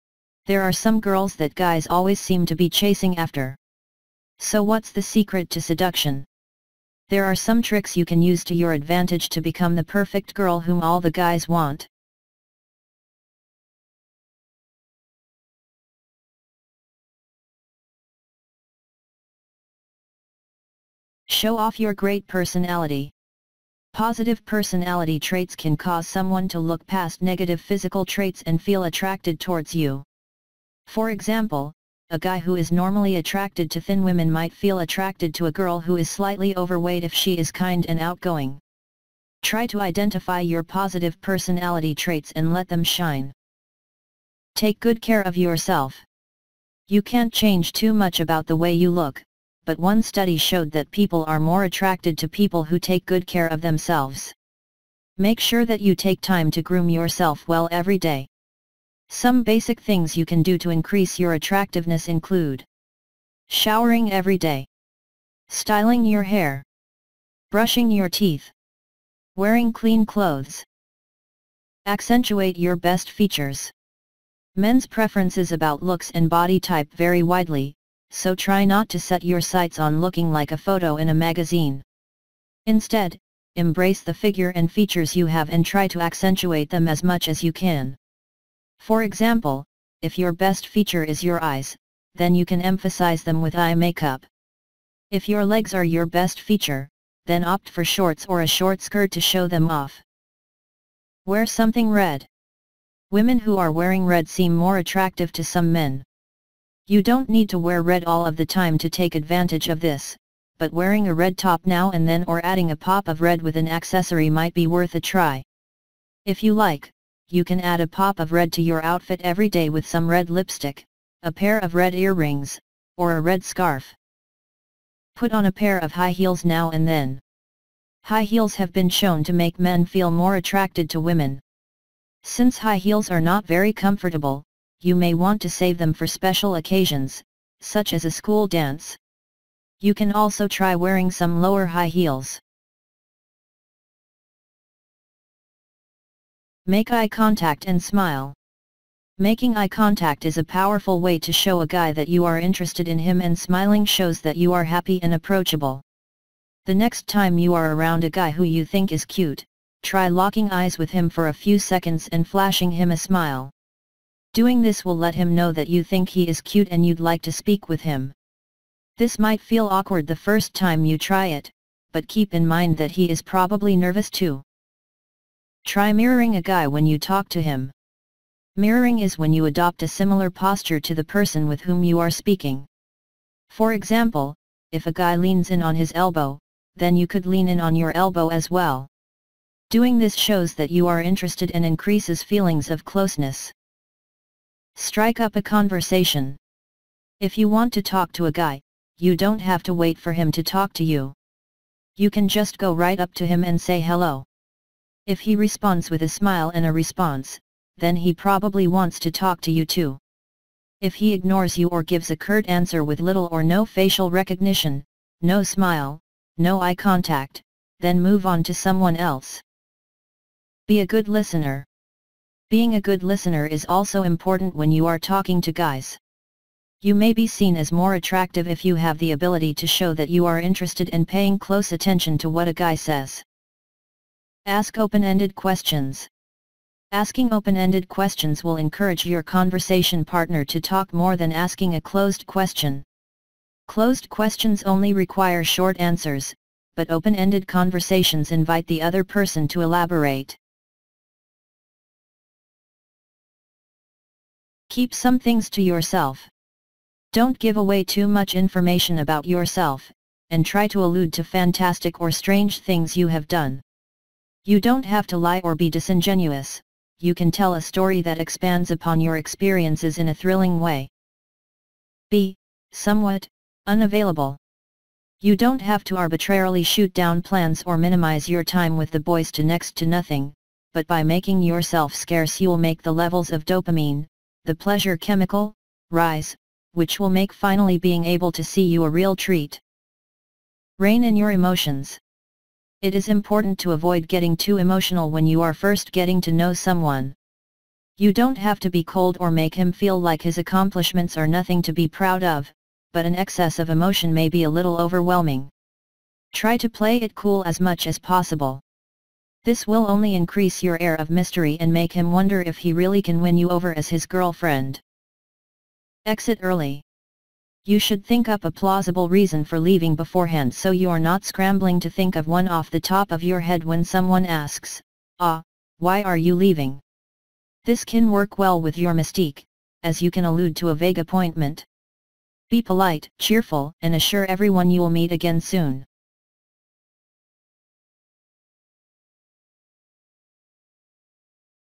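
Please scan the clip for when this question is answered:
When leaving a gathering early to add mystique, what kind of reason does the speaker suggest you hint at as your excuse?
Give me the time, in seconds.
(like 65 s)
330 s.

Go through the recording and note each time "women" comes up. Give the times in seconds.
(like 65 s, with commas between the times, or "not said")
34 s, 103 s, 130 s.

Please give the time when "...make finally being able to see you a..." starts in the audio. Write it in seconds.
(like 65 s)
287 s.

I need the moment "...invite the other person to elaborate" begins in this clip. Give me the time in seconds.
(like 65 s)
248 s.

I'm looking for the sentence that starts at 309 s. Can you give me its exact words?
This will only increase your air of mystery and make him wonder if he really can win you over as his girlfriend.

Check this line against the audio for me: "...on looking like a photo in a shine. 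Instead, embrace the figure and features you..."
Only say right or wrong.
wrong.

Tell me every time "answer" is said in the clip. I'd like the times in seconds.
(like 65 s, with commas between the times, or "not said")
212 s, 245 s.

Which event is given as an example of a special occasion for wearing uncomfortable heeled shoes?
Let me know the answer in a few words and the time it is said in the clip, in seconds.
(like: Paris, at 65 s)
a school dance, at 138 s.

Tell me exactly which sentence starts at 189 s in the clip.
Doing this shows that you are interested and increases feelings of closeness.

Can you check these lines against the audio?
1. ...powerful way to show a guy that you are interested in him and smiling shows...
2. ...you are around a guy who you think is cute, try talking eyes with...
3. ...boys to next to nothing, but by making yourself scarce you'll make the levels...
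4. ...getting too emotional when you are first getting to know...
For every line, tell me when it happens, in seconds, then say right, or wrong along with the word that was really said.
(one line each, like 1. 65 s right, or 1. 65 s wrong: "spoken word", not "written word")
1. 150 s right
2. 157 s wrong: "locking", not "talking"
3. 278 s right
4. 294 s right.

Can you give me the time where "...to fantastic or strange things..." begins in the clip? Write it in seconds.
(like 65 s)
261 s.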